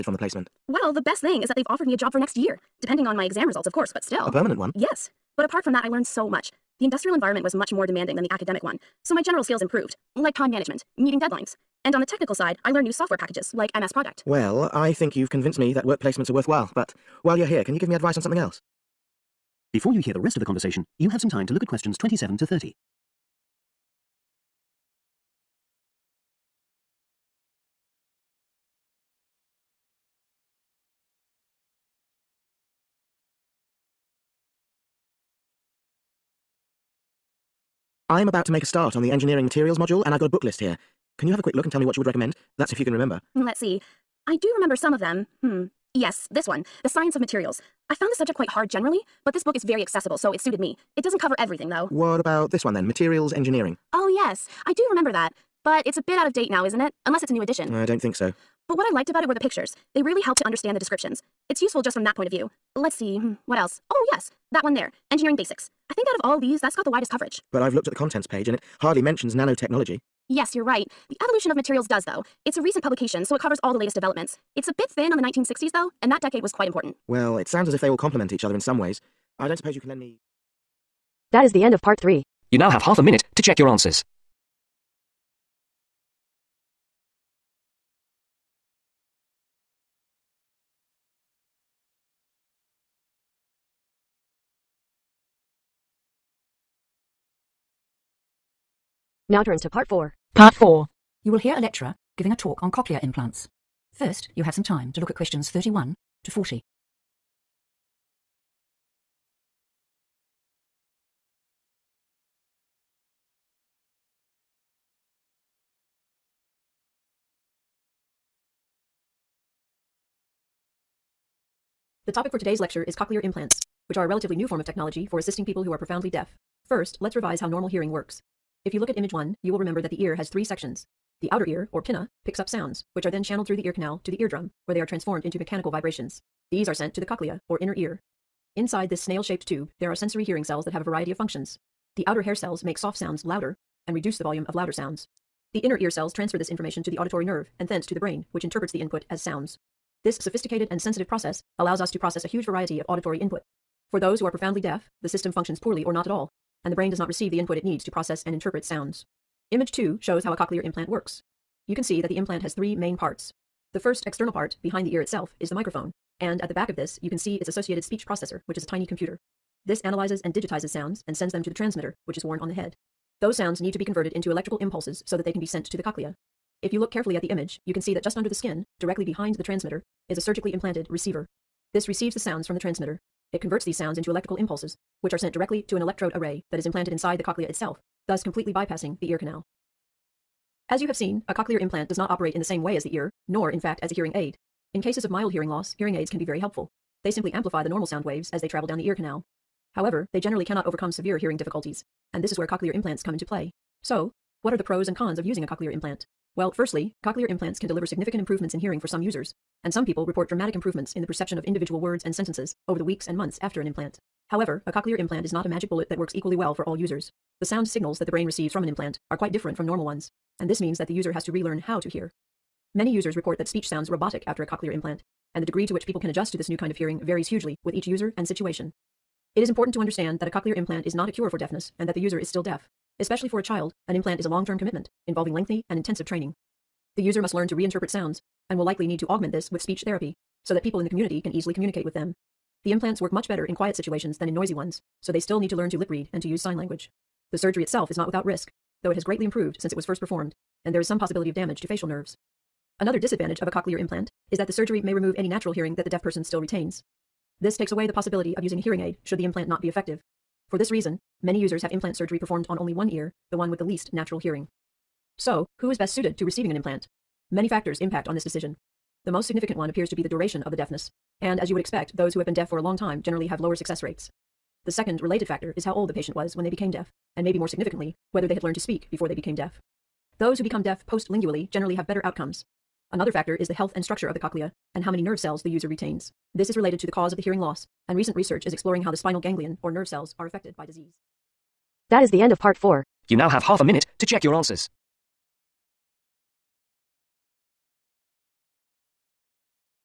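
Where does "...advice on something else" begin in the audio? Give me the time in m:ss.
0:17.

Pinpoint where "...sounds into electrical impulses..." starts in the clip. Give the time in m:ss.
3:03.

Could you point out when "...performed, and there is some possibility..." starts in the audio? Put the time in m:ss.
4:09.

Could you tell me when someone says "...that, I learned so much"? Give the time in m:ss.
0:05.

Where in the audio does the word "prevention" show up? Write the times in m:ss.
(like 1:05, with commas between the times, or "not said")
not said.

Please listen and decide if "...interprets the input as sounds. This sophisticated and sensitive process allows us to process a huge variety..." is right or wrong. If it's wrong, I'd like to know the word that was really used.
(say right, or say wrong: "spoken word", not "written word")
right.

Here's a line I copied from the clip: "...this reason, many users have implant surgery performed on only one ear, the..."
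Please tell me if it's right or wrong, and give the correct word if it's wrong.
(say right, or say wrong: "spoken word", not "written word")
right.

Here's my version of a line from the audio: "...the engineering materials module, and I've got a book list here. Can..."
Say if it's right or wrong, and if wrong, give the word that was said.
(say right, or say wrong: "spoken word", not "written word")
right.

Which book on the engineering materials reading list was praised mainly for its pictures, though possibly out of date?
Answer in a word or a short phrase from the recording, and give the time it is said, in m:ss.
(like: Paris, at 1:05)
Materials Engineering, at 0:52.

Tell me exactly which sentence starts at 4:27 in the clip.
Many factors impact on this decision.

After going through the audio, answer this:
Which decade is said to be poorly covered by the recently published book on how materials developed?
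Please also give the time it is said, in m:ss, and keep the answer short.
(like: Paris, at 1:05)
1960s, at 1:15.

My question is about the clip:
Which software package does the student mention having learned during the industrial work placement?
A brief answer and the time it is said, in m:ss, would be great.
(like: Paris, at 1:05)
MS Project, at 0:13.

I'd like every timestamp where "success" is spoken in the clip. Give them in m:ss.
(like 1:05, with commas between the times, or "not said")
4:33.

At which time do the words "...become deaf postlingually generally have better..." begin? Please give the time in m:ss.
4:40.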